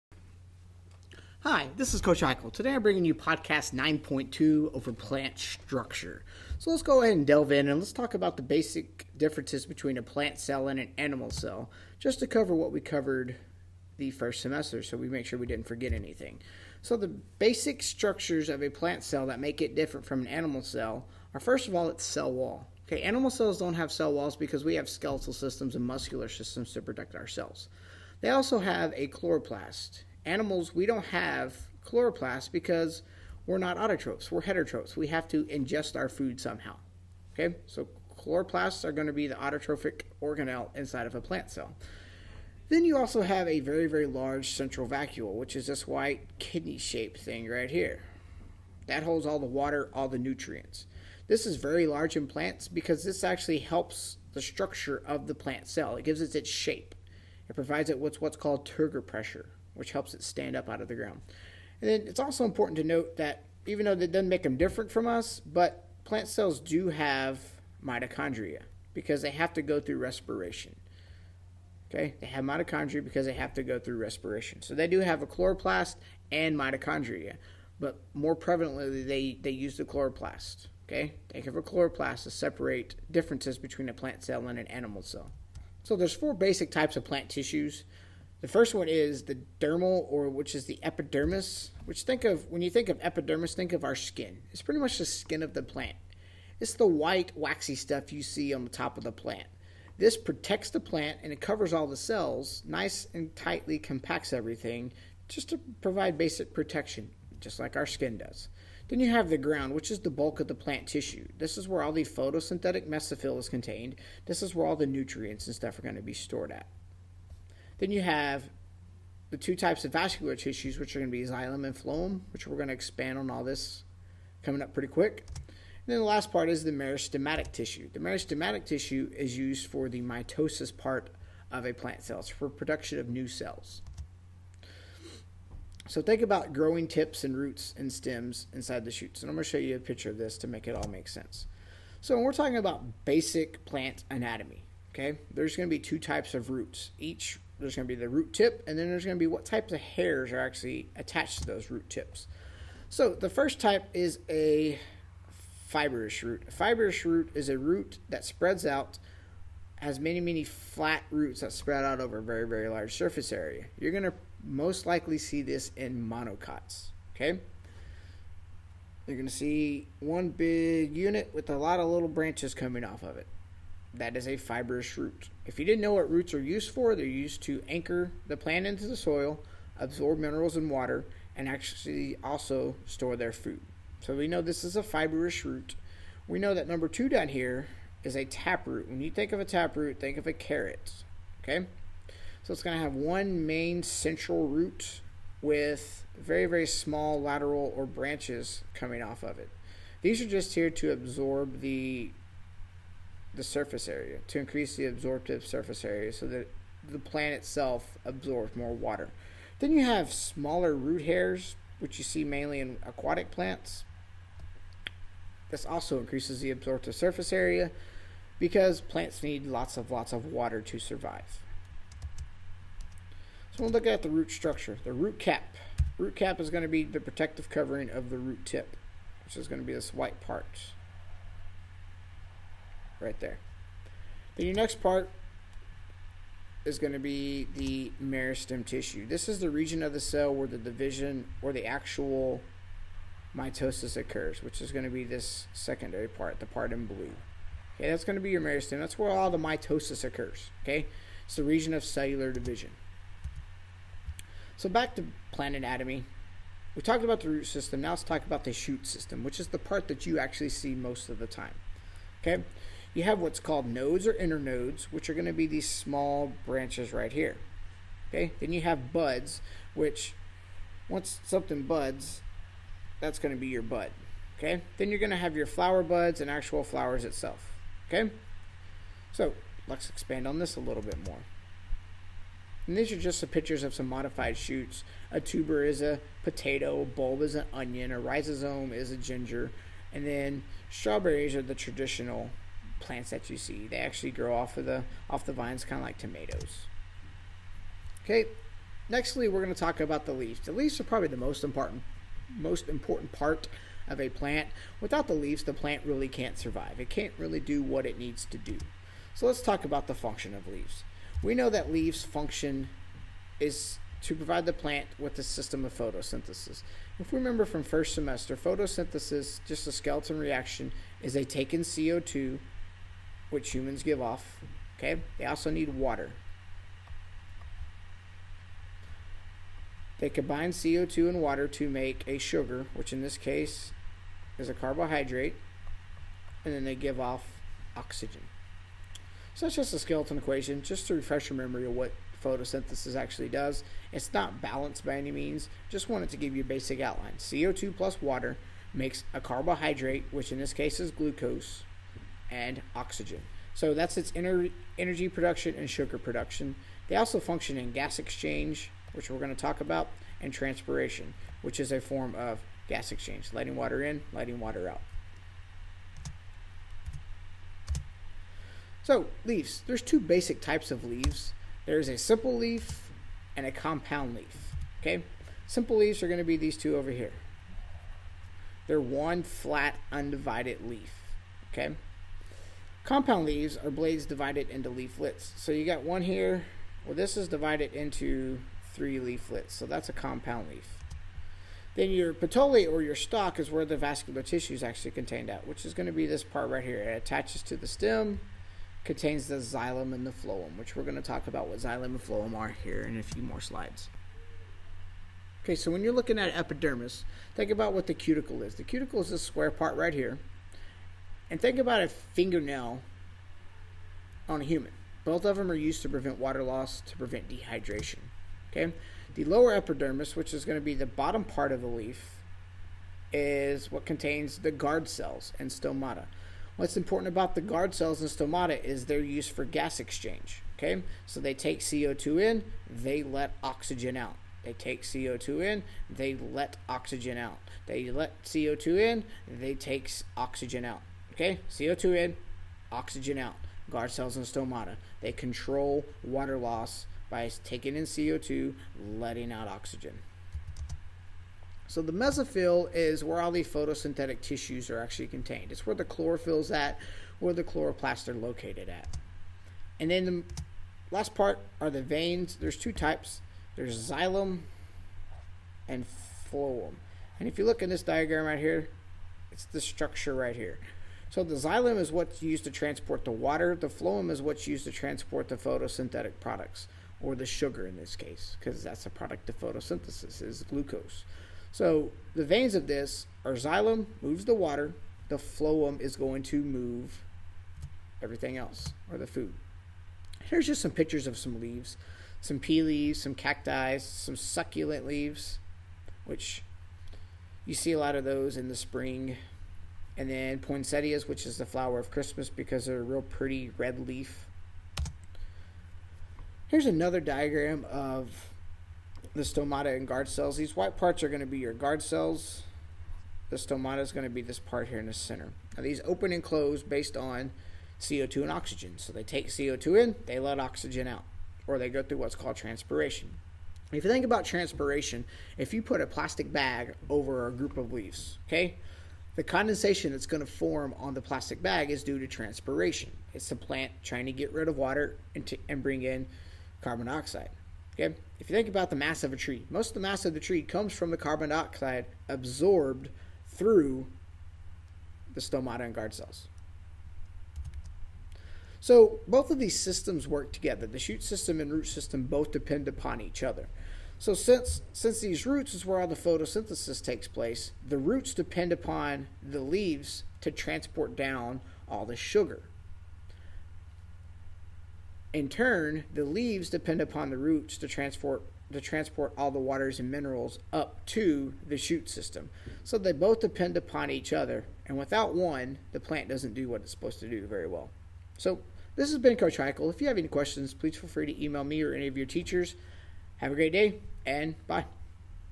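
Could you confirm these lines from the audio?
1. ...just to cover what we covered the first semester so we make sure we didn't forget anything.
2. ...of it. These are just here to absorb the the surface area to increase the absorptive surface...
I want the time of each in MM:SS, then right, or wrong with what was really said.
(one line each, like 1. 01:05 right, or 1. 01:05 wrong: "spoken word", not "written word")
1. 00:11 right
2. 03:19 right.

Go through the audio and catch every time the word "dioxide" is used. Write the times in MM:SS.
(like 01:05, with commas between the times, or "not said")
08:56, 09:01.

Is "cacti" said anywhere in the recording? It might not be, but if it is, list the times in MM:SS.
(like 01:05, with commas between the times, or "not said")
08:13.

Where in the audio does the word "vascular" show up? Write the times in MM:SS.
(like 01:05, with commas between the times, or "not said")
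01:59, 06:33.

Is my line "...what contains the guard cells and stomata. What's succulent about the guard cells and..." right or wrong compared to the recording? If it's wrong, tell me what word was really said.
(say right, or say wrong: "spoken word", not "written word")
wrong: "important", not "succulent".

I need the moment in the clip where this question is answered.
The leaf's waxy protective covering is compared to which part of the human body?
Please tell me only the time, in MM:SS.
06:51.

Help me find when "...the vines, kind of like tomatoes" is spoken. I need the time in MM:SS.
04:55.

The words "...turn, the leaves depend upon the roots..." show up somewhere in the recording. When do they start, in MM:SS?
09:25.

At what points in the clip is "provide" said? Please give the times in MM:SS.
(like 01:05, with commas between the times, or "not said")
00:57, 01:45, 05:14.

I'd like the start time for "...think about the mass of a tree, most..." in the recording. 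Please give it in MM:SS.
08:58.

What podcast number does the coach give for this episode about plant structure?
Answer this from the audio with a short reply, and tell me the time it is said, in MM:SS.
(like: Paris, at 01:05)
9.2, at 00:03.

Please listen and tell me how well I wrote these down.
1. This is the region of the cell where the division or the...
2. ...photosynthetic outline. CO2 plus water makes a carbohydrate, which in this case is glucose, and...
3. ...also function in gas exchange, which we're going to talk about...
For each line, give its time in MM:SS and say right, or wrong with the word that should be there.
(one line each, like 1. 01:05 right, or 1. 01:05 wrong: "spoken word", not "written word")
1. 03:59 right
2. 05:46 wrong: "basic", not "photosynthetic"
3. 05:56 right.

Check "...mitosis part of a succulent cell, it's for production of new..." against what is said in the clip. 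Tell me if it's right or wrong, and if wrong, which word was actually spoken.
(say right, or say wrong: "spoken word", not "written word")
wrong: "plant", not "succulent".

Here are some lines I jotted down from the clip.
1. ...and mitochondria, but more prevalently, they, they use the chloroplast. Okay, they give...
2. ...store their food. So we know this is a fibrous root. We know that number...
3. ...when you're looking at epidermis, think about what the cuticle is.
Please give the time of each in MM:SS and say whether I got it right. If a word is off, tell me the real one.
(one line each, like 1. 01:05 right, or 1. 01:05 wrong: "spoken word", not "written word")
1. 01:16 right
2. 03:02 right
3. 06:45 right.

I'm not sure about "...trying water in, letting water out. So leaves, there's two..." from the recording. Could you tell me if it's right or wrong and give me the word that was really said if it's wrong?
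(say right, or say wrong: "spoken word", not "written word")
wrong: "letting", not "trying".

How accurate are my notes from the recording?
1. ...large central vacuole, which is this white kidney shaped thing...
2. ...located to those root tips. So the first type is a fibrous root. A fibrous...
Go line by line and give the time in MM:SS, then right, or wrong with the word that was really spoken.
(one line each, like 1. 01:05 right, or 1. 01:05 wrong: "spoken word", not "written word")
1. 00:44 right
2. 02:30 wrong: "attached", not "located".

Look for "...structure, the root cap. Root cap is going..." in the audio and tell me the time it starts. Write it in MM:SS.
03:44.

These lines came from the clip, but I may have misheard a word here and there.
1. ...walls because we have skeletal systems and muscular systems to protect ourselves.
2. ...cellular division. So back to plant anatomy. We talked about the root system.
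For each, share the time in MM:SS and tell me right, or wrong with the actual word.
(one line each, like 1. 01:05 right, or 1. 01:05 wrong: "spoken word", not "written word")
1. 00:24 right
2. 04:11 right.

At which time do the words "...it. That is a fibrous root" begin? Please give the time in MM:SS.
02:53.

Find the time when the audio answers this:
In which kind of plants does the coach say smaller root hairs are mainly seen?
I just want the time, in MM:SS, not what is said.
03:32.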